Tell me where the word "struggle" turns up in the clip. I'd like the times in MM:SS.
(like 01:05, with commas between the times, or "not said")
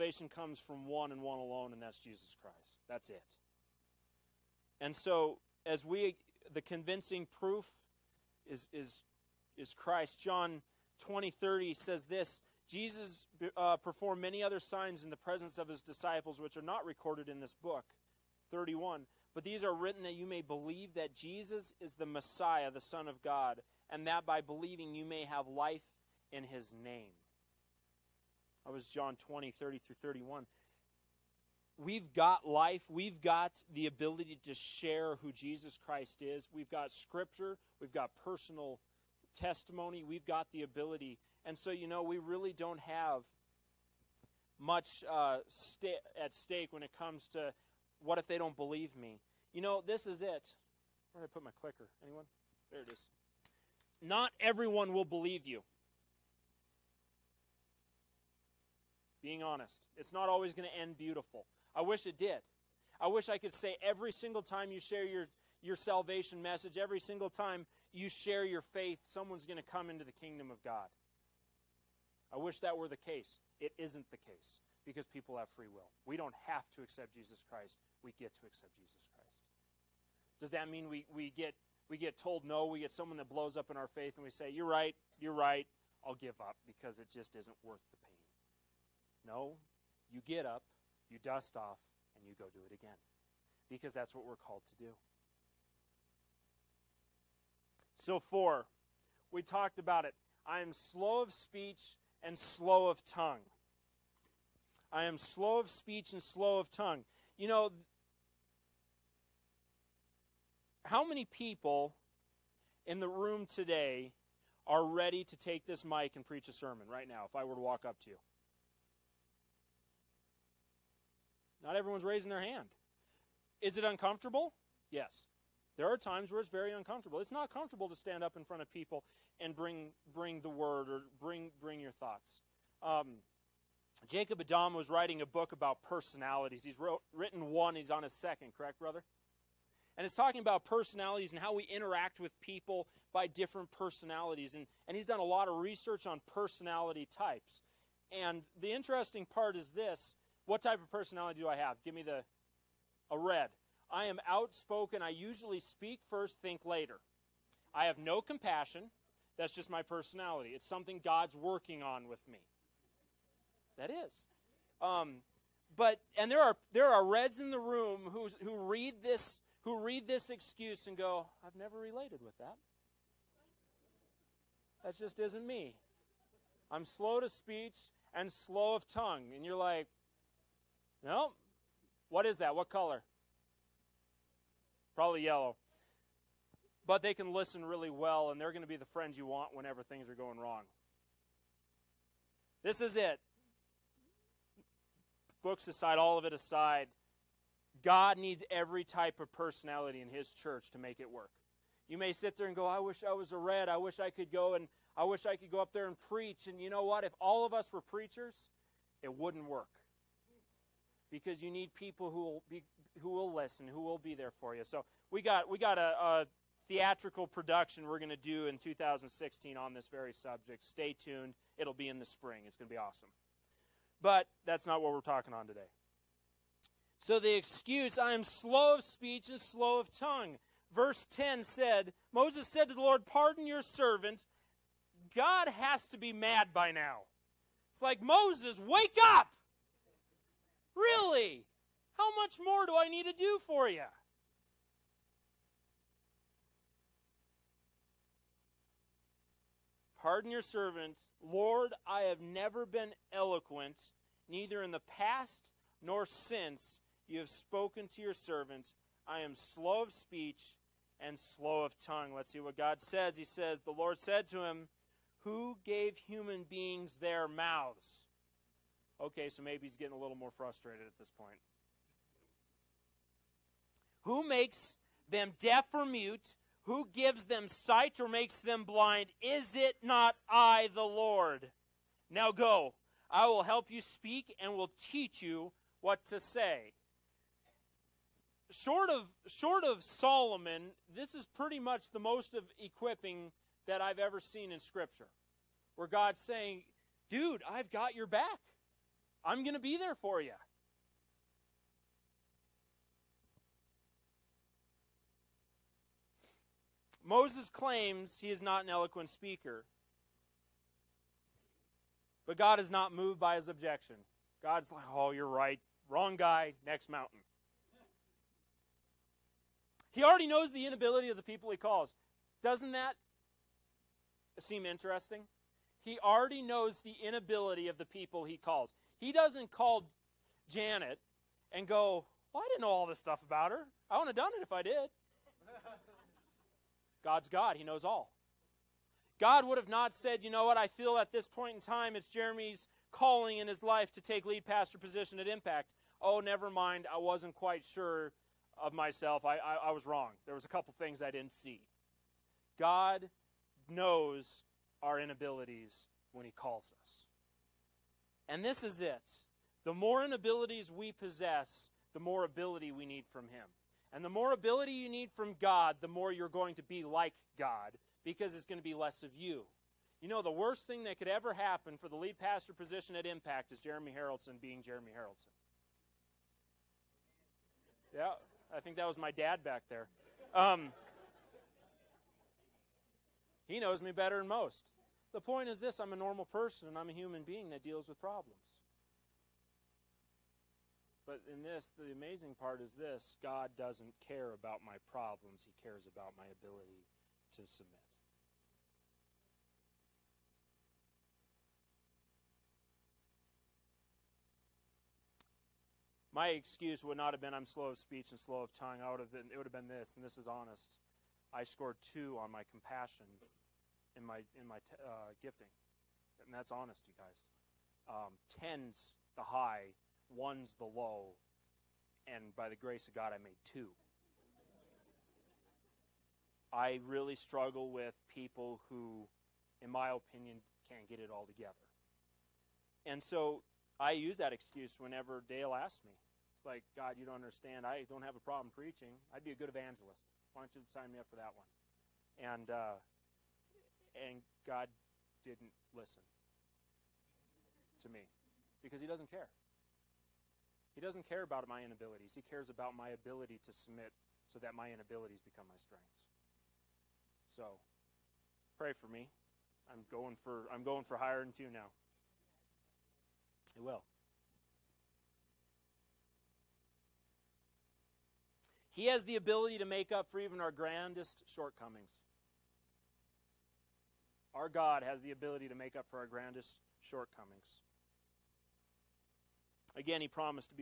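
07:07.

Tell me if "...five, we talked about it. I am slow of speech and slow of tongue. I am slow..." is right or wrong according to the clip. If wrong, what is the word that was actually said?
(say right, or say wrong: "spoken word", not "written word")
wrong: "four", not "five".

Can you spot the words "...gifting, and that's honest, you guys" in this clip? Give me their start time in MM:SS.
06:55.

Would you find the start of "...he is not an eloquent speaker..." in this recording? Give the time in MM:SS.
05:08.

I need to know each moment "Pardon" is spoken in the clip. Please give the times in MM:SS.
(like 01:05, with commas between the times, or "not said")
03:53, 04:10.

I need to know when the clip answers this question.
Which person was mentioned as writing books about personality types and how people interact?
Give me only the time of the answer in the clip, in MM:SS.
02:14.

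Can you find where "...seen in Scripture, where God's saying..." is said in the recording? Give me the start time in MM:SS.
04:54.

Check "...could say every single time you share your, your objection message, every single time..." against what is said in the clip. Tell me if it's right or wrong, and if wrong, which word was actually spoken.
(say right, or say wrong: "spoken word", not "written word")
wrong: "salvation", not "objection".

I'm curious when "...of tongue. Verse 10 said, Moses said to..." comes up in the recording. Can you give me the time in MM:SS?
03:49.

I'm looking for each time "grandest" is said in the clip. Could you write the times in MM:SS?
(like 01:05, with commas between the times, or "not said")
07:50, 07:56.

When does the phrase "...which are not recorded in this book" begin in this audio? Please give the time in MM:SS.
00:16.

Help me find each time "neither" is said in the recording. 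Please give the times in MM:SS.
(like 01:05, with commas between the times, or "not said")
04:14.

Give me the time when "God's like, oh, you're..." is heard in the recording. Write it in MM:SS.
05:14.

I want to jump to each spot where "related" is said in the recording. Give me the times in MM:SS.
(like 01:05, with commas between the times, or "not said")
02:51.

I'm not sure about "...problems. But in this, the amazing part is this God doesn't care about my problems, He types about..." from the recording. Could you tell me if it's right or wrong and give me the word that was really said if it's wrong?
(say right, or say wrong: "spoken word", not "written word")
wrong: "cares", not "types".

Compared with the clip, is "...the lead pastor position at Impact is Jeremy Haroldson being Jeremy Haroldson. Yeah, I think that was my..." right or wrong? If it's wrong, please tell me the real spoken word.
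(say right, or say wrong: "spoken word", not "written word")
right.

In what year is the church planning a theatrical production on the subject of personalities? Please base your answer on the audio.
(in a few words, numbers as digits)
2016.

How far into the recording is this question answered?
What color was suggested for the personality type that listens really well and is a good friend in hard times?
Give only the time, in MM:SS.
03:04.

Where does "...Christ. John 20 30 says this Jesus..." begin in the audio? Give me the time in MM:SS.
00:09.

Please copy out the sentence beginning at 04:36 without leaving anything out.
Who gives them sight or makes them blind?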